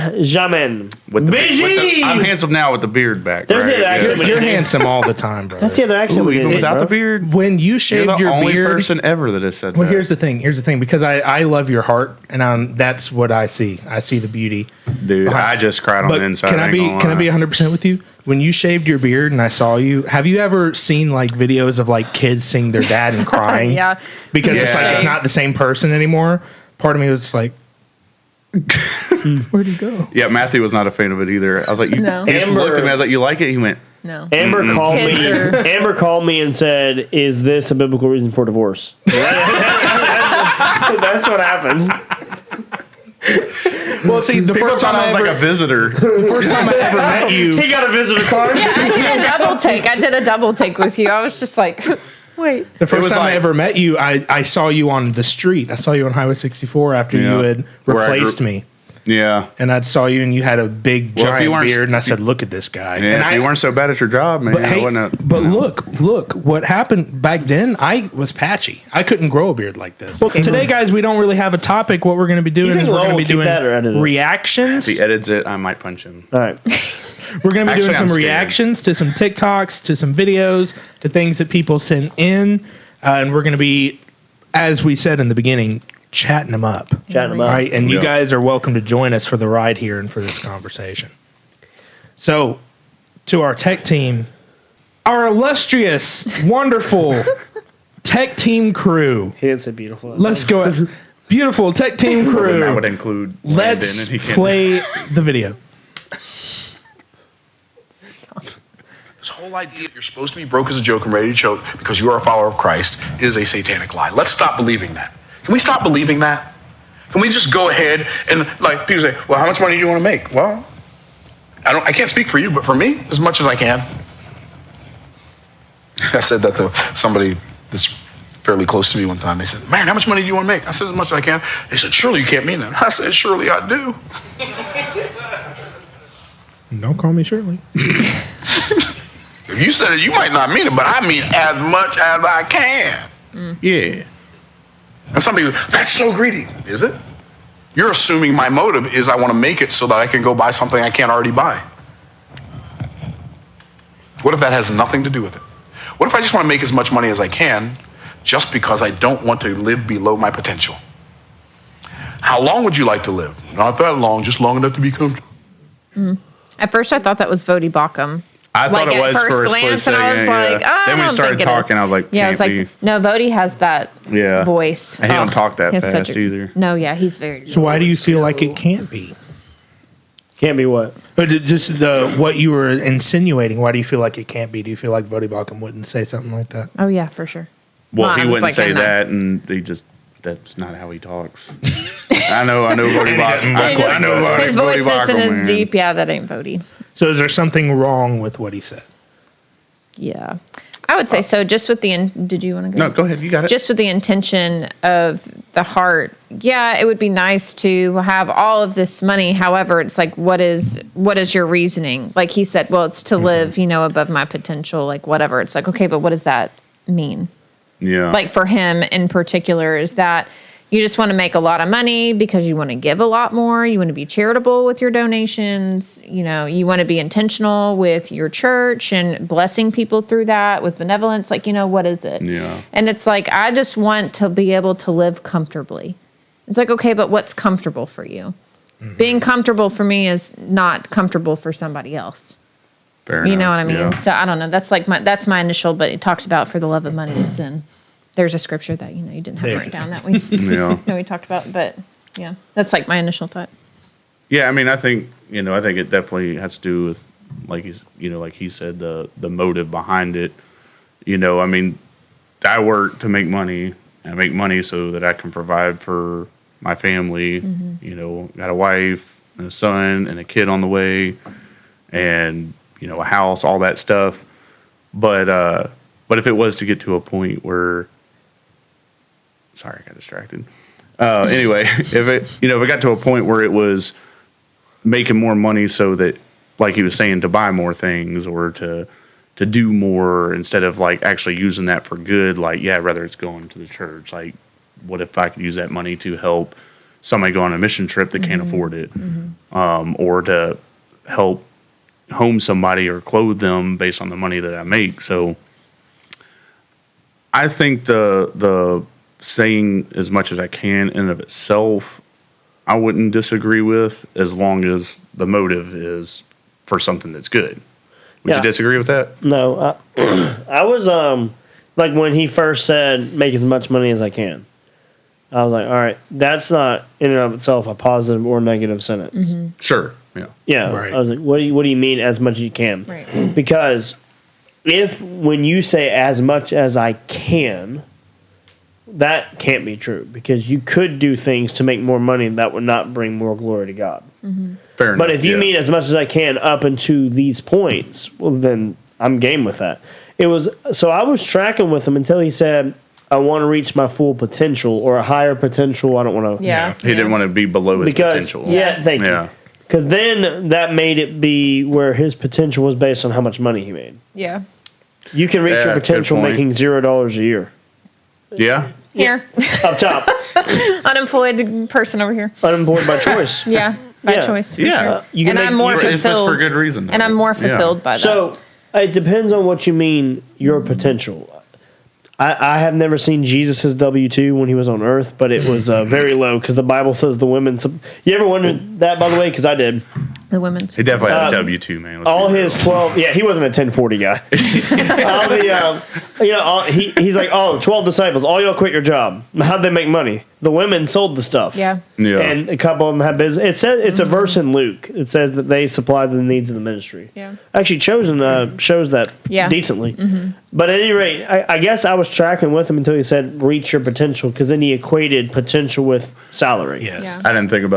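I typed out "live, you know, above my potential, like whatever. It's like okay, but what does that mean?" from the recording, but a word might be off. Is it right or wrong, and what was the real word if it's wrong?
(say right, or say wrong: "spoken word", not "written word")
right.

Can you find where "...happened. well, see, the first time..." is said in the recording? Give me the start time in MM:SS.
00:41.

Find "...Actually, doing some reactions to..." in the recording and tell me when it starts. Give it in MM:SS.
01:17.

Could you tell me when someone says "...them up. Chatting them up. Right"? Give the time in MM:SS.
01:26.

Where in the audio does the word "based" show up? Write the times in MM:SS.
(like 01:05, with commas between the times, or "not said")
05:03, 06:02.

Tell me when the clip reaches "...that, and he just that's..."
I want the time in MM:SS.
03:08.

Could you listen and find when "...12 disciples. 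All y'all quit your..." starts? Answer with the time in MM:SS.
06:37.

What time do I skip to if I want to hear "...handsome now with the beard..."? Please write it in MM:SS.
00:02.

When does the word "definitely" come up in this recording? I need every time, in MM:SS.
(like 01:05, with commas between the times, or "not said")
04:15, 06:30.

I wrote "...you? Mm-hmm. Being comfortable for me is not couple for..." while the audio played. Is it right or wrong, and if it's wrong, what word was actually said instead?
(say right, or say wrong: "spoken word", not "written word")
wrong: "comfortable", not "couple".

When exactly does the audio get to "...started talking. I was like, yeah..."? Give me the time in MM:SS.
02:51.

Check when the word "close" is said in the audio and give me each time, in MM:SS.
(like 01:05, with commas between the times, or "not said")
02:08.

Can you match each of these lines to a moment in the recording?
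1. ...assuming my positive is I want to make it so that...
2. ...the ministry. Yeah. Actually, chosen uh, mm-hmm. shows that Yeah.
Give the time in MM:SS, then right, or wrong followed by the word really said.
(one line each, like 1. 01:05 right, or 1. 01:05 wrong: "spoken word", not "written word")
1. 02:27 wrong: "motive", not "positive"
2. 06:46 right.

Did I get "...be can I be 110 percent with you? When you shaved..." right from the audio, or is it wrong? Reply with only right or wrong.
wrong.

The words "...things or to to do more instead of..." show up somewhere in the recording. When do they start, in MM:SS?
04:47.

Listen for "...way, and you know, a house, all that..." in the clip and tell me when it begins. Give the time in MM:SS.
04:30.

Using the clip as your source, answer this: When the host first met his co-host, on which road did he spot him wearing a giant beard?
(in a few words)
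Highway 64.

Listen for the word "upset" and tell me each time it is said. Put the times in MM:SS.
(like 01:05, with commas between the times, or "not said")
not said.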